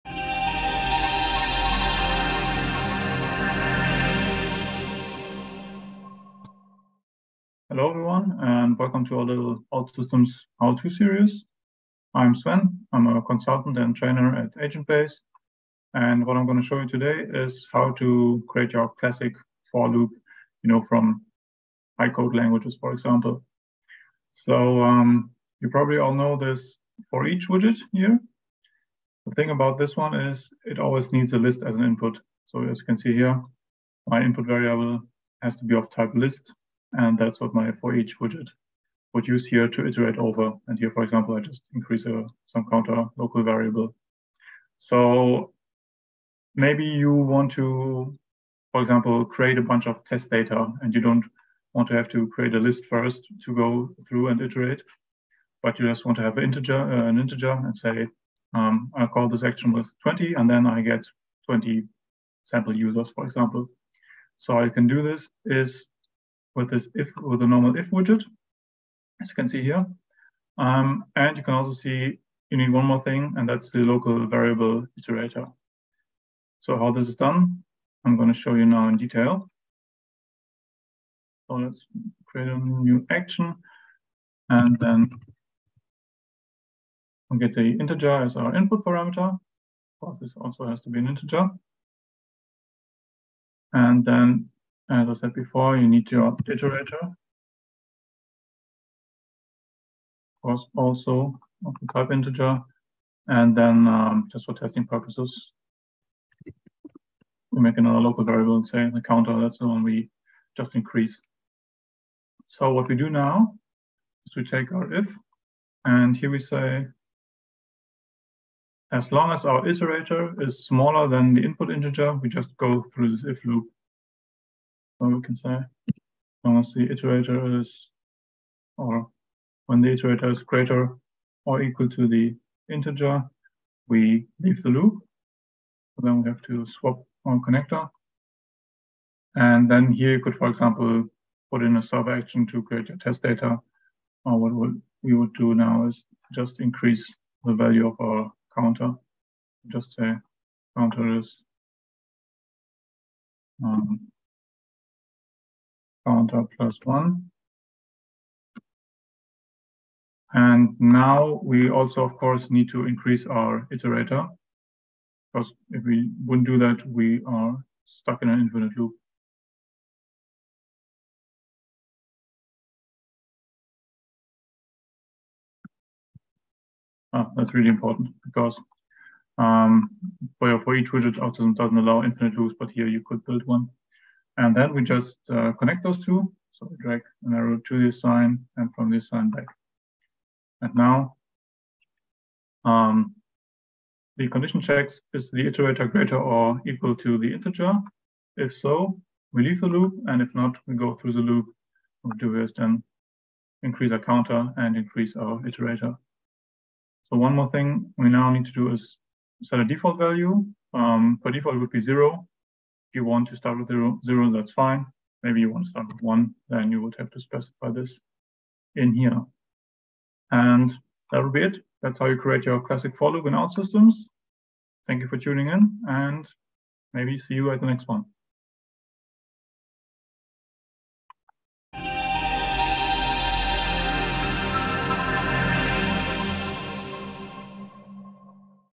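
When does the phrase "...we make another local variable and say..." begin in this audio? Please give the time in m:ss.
1:46.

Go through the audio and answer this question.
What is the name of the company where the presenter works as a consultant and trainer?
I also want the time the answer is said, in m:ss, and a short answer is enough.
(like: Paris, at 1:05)
AgentBase, at 0:14.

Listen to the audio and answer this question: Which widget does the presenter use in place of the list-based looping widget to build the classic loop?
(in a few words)
If widget.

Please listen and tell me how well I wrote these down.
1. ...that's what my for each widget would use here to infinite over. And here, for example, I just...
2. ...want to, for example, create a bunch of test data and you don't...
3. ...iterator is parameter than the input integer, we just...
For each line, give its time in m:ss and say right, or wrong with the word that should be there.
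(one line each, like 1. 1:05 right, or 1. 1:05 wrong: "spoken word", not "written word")
1. 0:37 wrong: "iterate", not "infinite"
2. 0:47 right
3. 1:59 wrong: "smaller", not "parameter".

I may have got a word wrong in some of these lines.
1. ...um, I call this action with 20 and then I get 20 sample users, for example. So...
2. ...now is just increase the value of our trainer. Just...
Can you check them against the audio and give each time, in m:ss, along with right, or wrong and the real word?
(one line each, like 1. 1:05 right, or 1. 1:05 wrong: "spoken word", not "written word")
1. 0:58 right
2. 2:25 wrong: "counter", not "trainer".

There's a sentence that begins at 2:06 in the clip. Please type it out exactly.
Unless the iterator is, or when the iterator is greater or equal to the integer, we leave the loop.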